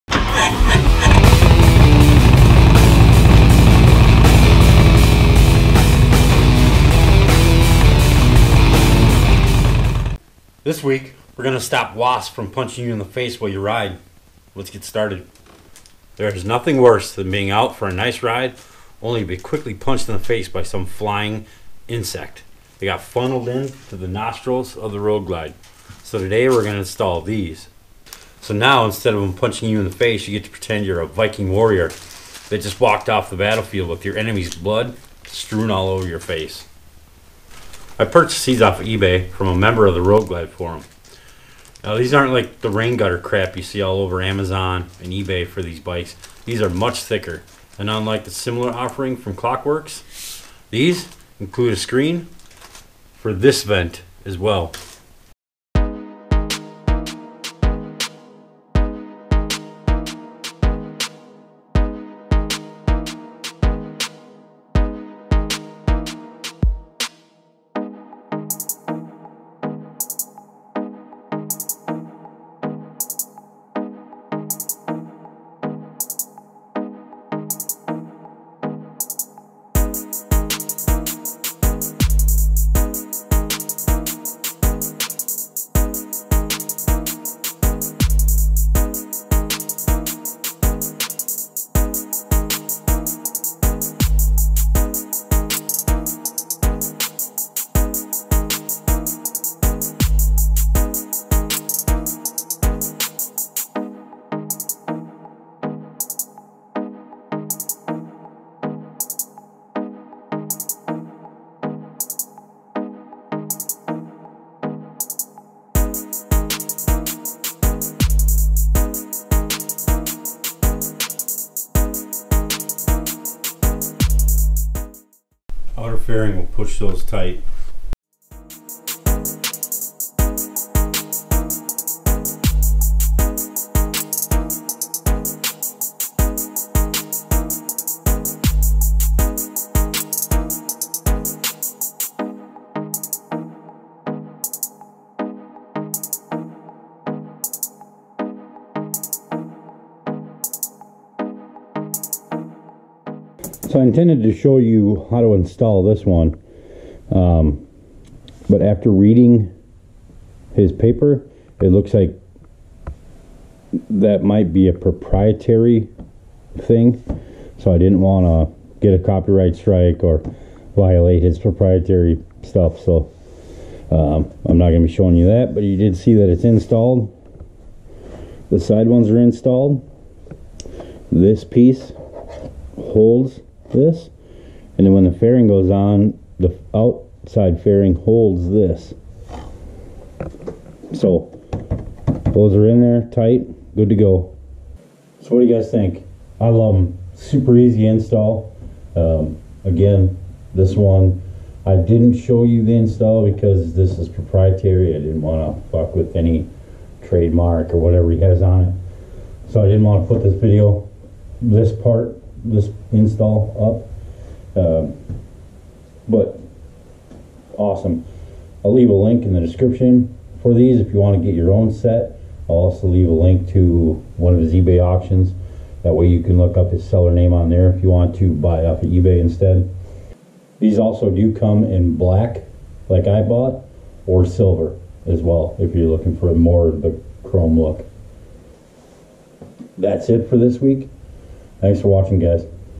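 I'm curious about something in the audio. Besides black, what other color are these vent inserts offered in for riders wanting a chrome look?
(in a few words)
silver.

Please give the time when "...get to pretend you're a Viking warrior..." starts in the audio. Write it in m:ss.
0:30.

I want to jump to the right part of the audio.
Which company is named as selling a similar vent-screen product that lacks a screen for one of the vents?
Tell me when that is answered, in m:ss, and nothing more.
0:49.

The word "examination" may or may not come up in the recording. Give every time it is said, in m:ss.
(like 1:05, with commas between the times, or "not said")
not said.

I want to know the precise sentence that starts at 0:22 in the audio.
They got funneled in to the nostrils of the road glide.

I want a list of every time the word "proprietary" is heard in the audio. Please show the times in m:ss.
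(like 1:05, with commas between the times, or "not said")
2:44, 2:51, 3:24.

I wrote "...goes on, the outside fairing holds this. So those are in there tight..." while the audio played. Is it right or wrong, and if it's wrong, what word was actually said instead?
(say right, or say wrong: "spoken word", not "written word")
right.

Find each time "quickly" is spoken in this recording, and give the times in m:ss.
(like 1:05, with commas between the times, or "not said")
0:19.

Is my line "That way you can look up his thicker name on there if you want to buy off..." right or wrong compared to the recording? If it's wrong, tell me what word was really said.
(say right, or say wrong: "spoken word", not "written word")
wrong: "seller", not "thicker".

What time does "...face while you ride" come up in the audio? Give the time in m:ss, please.
0:13.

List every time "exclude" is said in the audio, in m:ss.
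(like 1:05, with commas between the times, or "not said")
not said.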